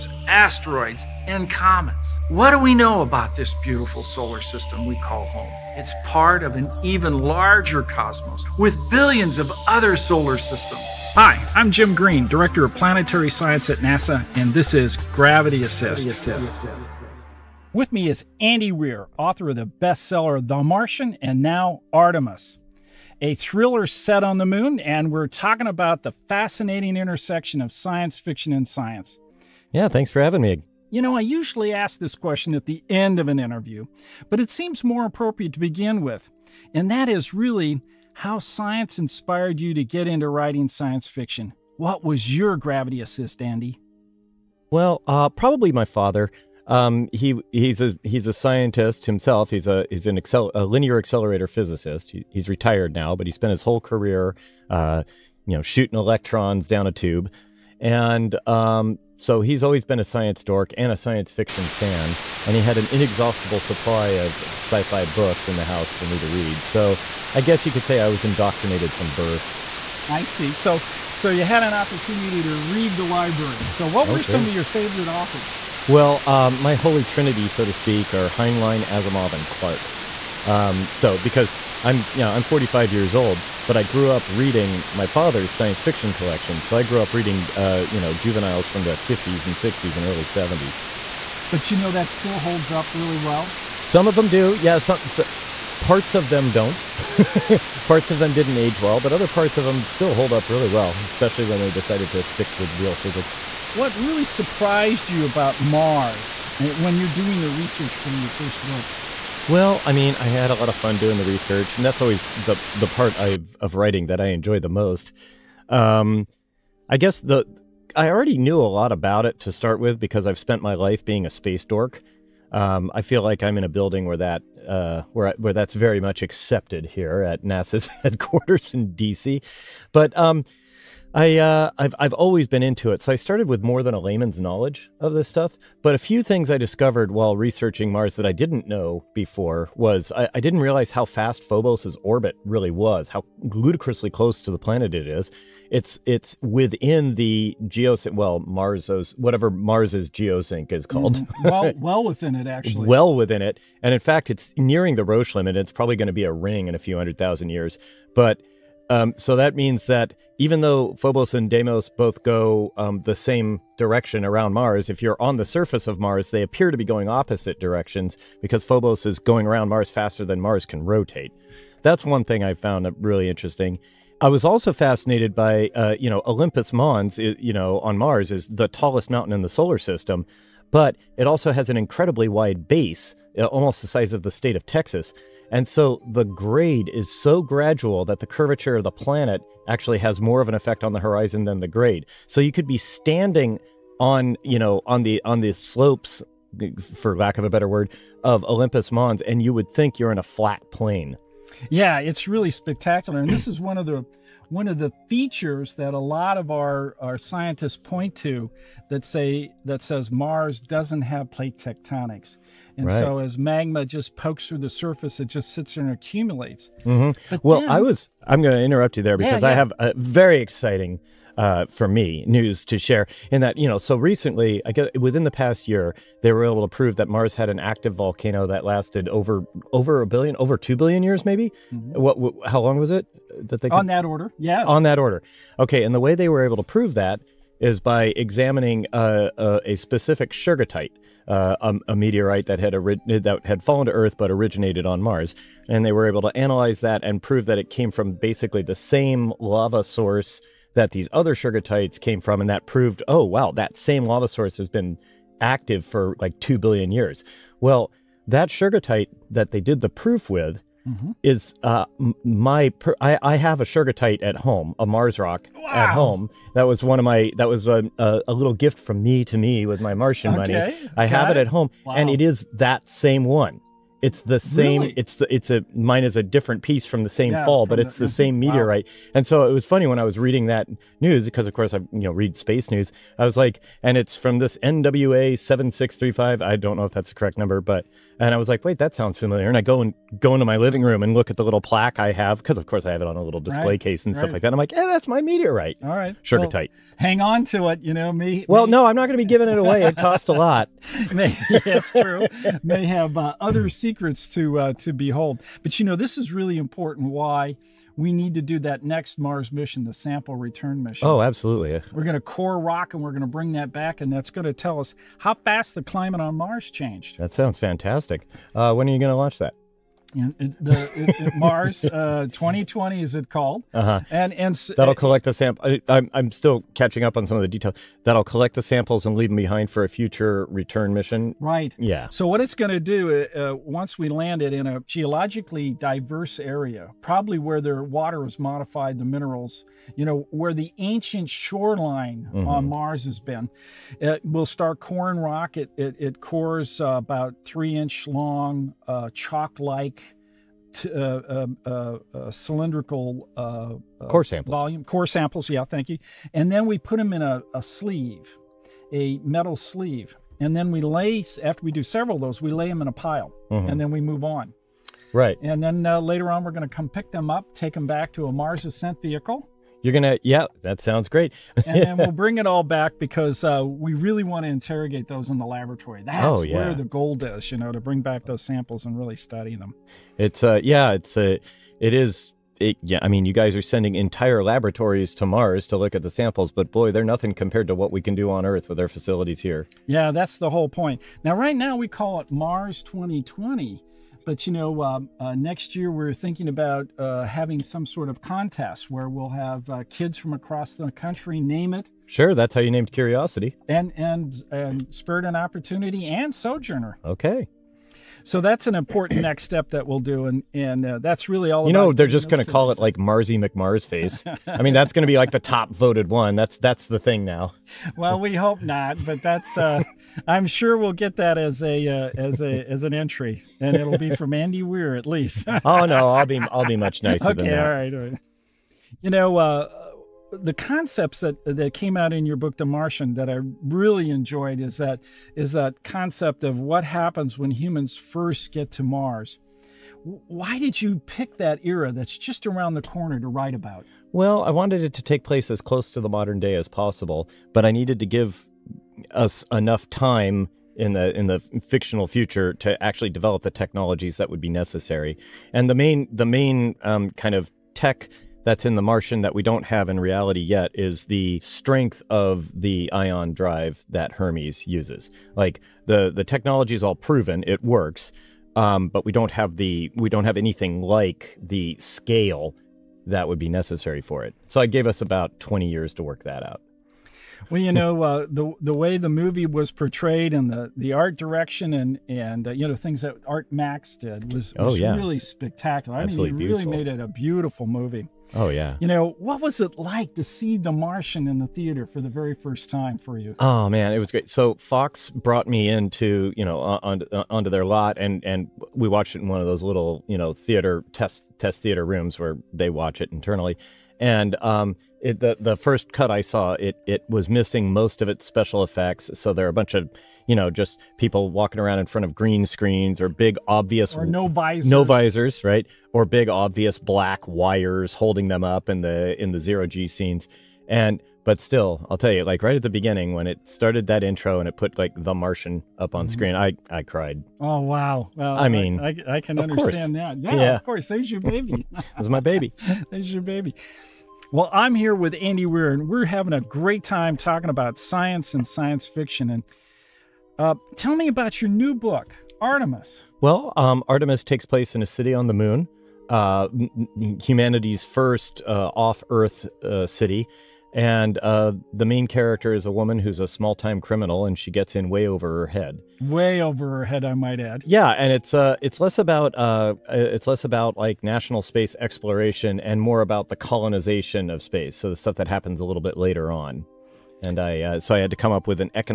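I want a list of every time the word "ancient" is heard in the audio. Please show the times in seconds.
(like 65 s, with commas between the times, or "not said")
340 s.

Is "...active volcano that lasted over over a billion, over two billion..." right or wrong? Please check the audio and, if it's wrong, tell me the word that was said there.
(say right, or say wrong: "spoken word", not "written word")
right.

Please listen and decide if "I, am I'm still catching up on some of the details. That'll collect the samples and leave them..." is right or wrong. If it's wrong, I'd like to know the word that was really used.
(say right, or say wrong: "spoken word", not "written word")
right.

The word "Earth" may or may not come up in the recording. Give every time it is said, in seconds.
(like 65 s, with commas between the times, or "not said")
243 s, 388 s, 549 s.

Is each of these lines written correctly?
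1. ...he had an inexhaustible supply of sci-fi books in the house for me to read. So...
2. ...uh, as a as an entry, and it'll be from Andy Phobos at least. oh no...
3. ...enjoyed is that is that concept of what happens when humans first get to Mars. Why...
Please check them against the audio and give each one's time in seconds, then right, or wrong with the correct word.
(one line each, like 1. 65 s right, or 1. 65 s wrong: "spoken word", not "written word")
1. 62 s right
2. 421 s wrong: "Weir", not "Phobos"
3. 434 s right.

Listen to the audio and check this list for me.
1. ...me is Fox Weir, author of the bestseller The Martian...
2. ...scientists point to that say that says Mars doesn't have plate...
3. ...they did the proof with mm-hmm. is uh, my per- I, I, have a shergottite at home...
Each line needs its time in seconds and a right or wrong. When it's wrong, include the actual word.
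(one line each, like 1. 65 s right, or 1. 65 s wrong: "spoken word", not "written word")
1. 17 s wrong: "Andy", not "Fox"
2. 207 s right
3. 259 s right.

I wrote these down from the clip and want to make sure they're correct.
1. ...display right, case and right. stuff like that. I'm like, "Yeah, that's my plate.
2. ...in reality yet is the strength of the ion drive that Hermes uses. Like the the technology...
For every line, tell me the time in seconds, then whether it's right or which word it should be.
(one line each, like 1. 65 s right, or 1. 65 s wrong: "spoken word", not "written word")
1. 293 s wrong: "meteorite", not "plate"
2. 459 s right.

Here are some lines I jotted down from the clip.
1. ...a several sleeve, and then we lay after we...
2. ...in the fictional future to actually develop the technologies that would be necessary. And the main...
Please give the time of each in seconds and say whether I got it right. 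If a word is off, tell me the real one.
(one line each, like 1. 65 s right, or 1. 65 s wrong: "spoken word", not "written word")
1. 358 s wrong: "metal", not "several"
2. 451 s right.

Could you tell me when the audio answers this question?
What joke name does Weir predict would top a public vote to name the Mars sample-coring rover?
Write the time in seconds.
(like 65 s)
412 s.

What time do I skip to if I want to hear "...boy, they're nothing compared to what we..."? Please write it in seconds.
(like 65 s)
386 s.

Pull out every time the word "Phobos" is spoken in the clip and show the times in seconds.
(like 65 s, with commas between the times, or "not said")
141 s, 160 s, 168 s.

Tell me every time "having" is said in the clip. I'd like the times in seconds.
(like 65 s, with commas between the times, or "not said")
30 s, 397 s, 536 s.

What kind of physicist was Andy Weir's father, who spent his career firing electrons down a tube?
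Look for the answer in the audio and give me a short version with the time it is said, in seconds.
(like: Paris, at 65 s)
Linear accelerator physicist, at 50 s.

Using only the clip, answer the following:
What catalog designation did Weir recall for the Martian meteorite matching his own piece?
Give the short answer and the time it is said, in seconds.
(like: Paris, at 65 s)
NWA 7635, at 284 s.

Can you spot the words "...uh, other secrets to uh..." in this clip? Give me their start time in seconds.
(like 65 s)
303 s.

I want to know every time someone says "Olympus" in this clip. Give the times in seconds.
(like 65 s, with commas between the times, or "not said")
176 s, 198 s.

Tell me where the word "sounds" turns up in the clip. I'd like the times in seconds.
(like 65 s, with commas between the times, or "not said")
288 s, 317 s, 370 s.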